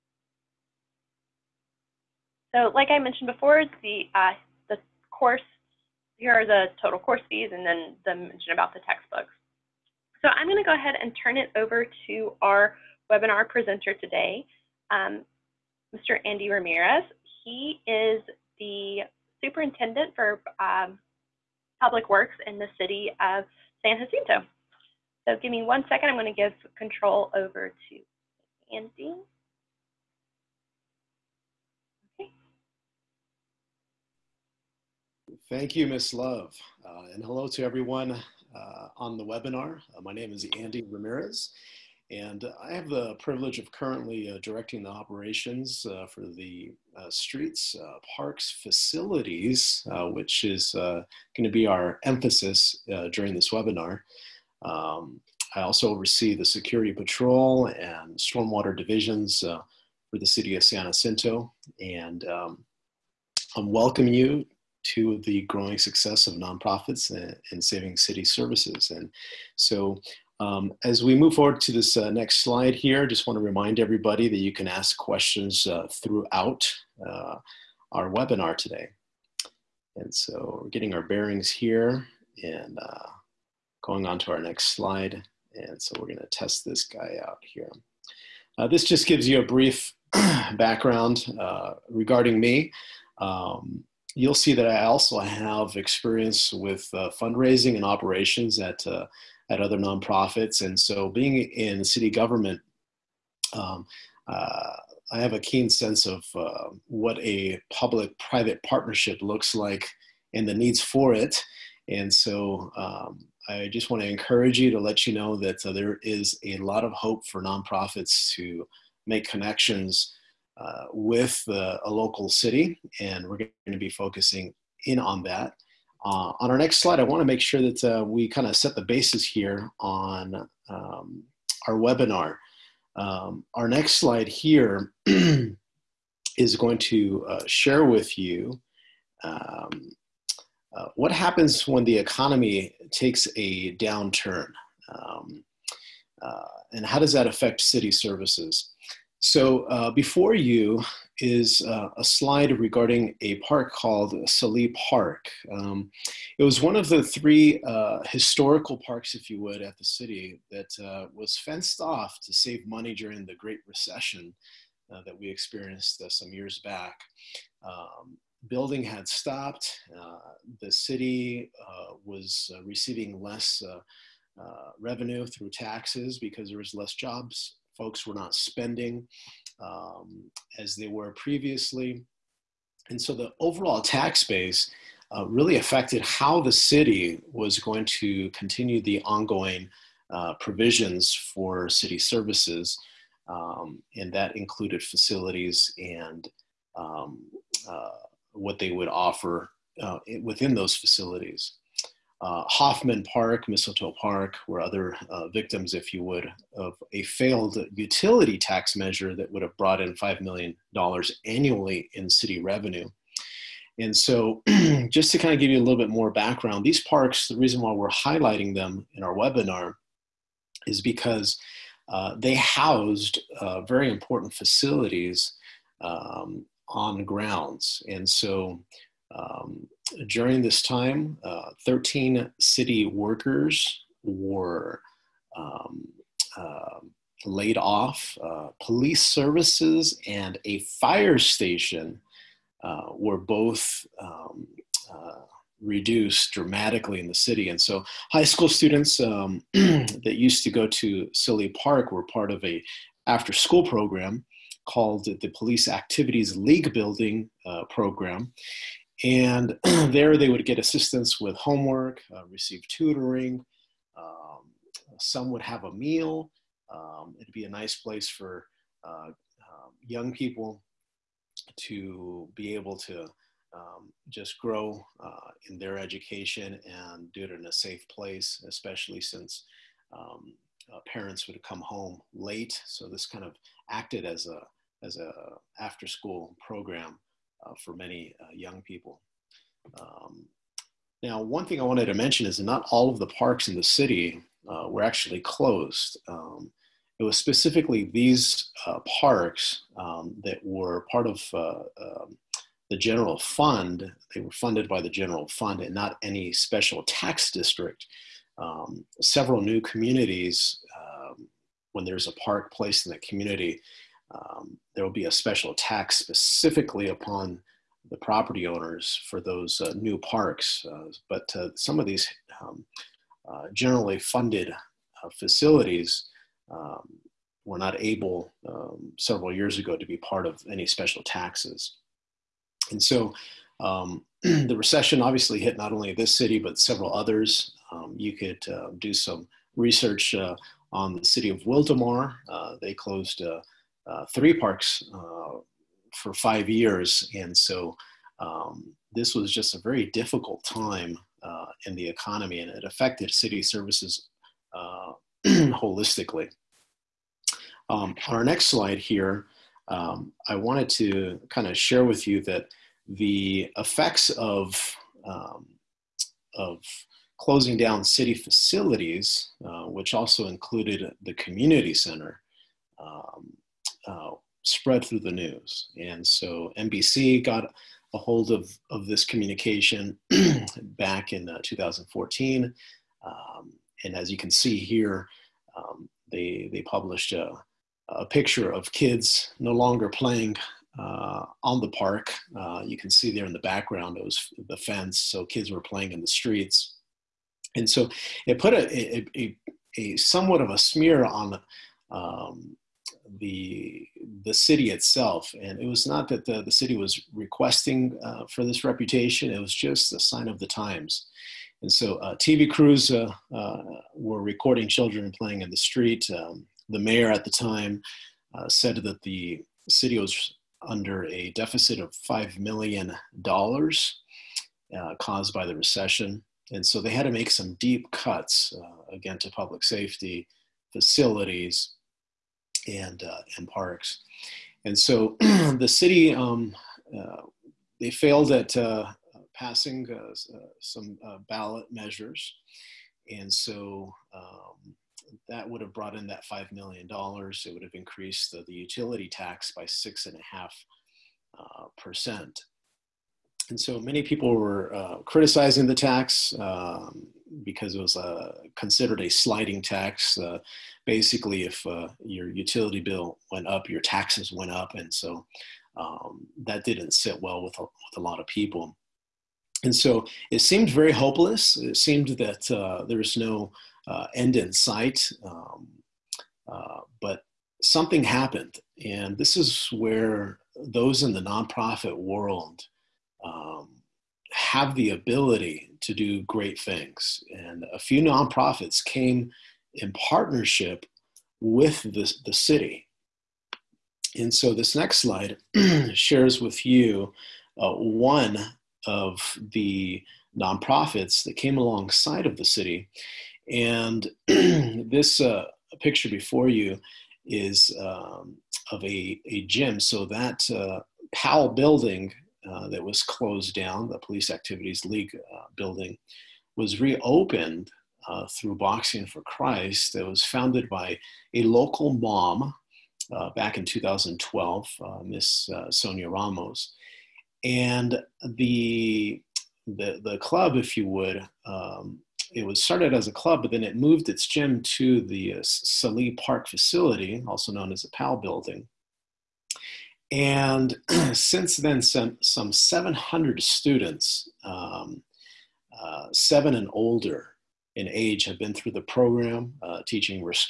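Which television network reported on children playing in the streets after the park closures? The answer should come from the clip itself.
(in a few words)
NBC.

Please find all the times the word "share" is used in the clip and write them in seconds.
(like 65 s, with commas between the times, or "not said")
137 s, 361 s, 495 s.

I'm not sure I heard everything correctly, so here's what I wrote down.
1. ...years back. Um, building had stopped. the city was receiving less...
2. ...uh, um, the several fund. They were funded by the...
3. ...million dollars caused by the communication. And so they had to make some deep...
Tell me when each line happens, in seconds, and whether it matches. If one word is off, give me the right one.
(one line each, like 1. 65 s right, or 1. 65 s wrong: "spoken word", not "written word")
1. 166 s right
2. 301 s wrong: "general", not "several"
3. 422 s wrong: "recession", not "communication".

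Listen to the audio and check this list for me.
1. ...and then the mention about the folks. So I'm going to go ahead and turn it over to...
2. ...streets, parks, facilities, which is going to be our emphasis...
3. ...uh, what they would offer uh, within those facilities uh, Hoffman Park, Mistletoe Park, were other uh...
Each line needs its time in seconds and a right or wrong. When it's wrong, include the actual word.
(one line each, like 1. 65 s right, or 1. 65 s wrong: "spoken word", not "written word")
1. 7 s wrong: "textbooks", not "folks"
2. 47 s right
3. 197 s right.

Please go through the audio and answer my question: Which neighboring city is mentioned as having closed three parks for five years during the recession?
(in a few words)
Wildomar.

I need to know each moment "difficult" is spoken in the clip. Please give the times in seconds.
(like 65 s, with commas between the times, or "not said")
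349 s.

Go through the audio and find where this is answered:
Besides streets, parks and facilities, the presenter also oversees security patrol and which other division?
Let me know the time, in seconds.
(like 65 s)
58 s.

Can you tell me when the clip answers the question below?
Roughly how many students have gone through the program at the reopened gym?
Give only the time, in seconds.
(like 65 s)
542 s.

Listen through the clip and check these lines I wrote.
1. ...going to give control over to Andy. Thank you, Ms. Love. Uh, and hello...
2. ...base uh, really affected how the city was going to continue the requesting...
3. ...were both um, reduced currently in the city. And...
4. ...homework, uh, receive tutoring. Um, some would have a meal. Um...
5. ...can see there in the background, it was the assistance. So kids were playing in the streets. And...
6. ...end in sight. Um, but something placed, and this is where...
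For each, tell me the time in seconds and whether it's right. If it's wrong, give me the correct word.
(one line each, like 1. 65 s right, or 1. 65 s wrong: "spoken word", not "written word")
1. 26 s right
2. 184 s wrong: "ongoing", not "requesting"
3. 242 s wrong: "dramatically", not "currently"
4. 261 s right
5. 392 s wrong: "fence", not "assistance"
6. 474 s wrong: "happened", not "placed".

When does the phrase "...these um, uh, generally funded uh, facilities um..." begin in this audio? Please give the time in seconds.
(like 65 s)
321 s.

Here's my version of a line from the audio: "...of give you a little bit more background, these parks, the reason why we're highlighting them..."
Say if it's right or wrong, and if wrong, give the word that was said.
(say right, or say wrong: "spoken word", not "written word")
right.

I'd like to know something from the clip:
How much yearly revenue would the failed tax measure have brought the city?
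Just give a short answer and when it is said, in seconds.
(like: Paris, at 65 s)
$5 million, at 209 s.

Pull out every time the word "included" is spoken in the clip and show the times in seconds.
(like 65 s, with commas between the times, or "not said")
194 s, 370 s.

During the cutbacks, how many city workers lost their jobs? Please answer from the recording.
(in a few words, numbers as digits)
13.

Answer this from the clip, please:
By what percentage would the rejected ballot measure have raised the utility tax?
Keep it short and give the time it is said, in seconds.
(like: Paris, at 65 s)
6.5%, at 449 s.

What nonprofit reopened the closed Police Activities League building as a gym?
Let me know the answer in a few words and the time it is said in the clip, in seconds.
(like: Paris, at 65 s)
Boxing for Christ, at 518 s.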